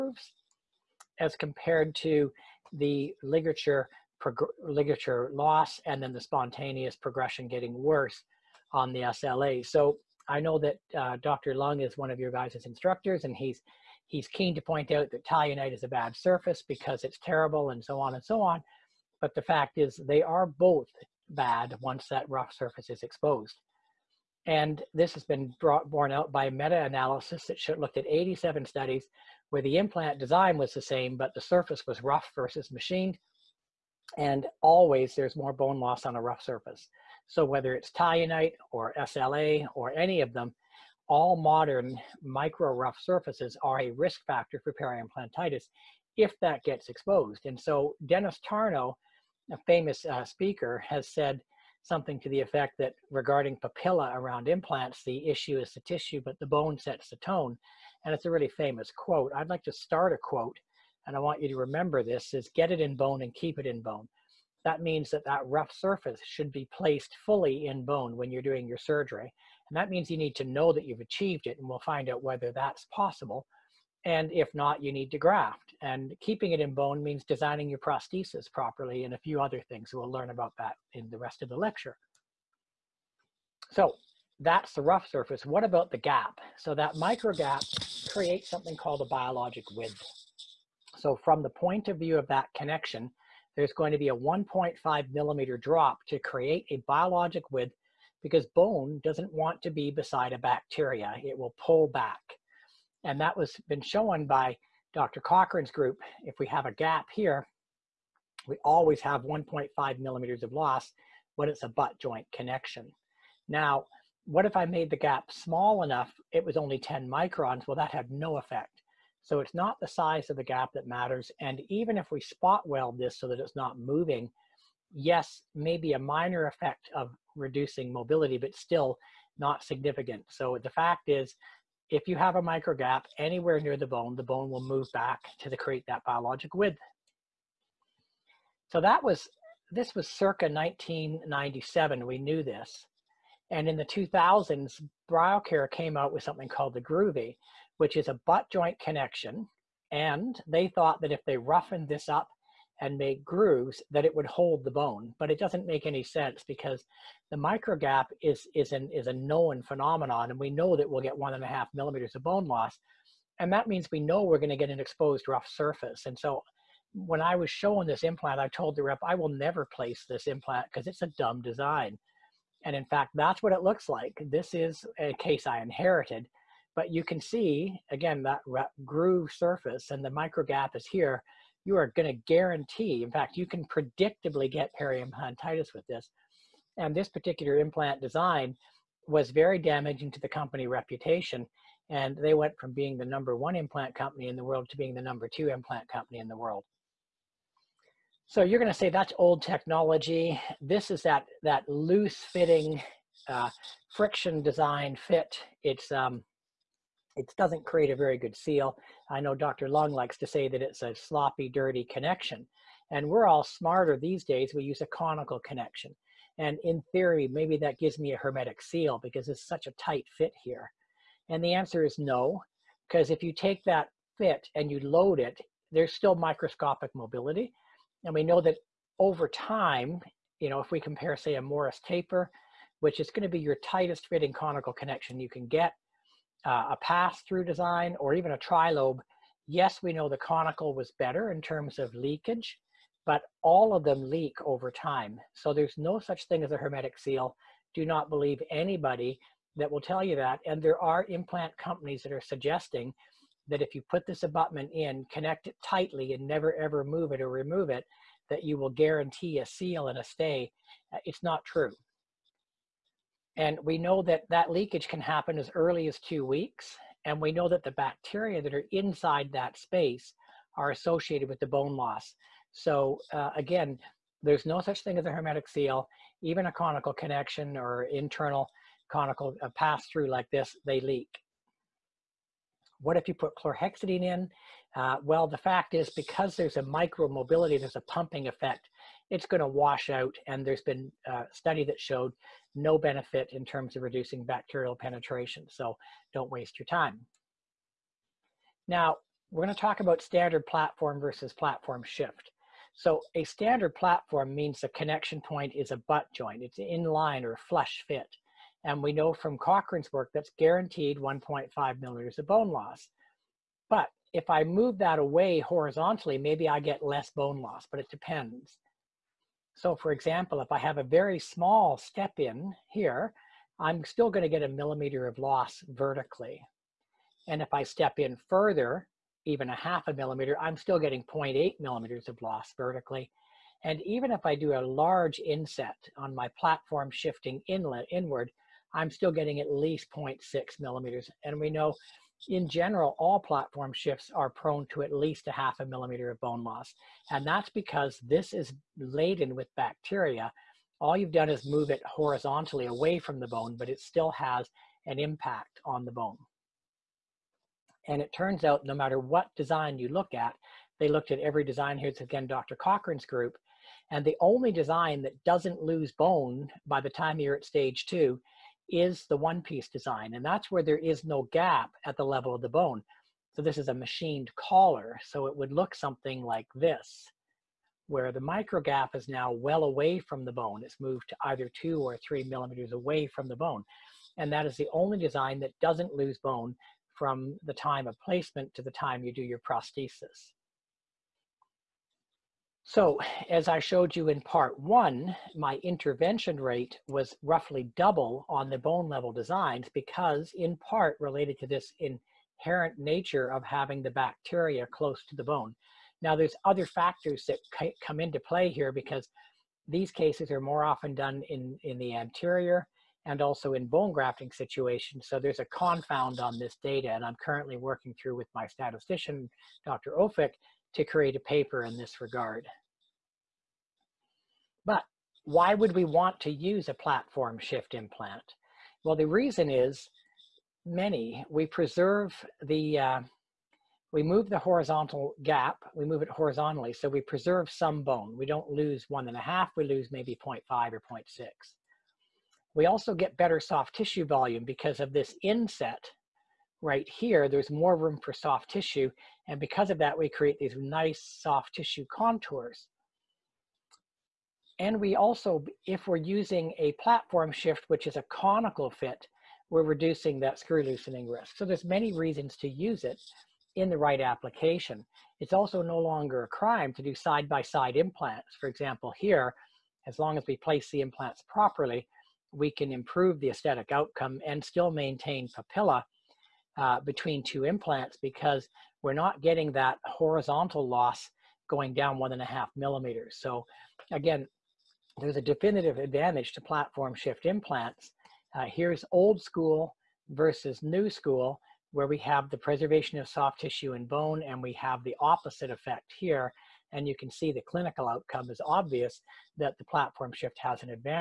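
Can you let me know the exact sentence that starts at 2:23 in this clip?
And in the 2000s, BioCare came out with something called the Groovy, which is a butt joint connection.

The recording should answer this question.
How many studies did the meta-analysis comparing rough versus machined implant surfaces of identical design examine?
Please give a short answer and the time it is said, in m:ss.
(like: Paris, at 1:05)
87, at 0:28.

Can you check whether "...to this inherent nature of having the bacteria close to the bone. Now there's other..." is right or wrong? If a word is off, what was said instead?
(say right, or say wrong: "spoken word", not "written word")
right.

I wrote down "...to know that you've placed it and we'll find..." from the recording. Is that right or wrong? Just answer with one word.
wrong.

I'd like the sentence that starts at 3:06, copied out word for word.
And this particular implant design was very damaging to the company reputation.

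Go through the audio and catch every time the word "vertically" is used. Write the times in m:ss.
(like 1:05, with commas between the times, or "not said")
5:25, 5:32.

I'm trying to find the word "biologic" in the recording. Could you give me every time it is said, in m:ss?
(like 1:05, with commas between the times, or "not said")
1:29, 1:36, 2:16.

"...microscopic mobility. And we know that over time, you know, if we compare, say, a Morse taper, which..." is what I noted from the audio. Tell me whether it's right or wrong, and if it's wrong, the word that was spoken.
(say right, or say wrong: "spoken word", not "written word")
right.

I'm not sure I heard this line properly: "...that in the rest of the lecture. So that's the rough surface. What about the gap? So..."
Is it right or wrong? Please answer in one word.
right.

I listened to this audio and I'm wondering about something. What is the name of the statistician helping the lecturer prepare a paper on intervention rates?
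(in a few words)
Dr. Ofik.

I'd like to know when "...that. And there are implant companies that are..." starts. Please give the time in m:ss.
4:10.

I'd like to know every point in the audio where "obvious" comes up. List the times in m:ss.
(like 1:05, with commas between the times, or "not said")
8:18.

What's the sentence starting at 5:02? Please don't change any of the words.
So a standard platform means the connection point is a butt joint.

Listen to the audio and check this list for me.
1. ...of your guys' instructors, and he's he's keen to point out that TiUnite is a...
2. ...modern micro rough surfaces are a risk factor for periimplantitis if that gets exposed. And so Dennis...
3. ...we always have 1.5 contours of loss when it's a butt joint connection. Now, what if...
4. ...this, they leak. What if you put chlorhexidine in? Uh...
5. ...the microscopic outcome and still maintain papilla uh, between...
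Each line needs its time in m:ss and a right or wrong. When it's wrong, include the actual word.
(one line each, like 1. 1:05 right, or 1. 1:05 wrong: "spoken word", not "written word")
1. 0:12 right
2. 0:41 right
3. 1:48 wrong: "millimeters", not "contours"
4. 4:40 right
5. 7:53 wrong: "aesthetic", not "microscopic".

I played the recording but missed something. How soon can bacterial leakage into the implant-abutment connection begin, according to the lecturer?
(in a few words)
2 weeks.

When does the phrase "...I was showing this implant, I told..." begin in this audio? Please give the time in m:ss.
2:47.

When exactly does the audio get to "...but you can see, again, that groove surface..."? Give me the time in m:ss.
2:56.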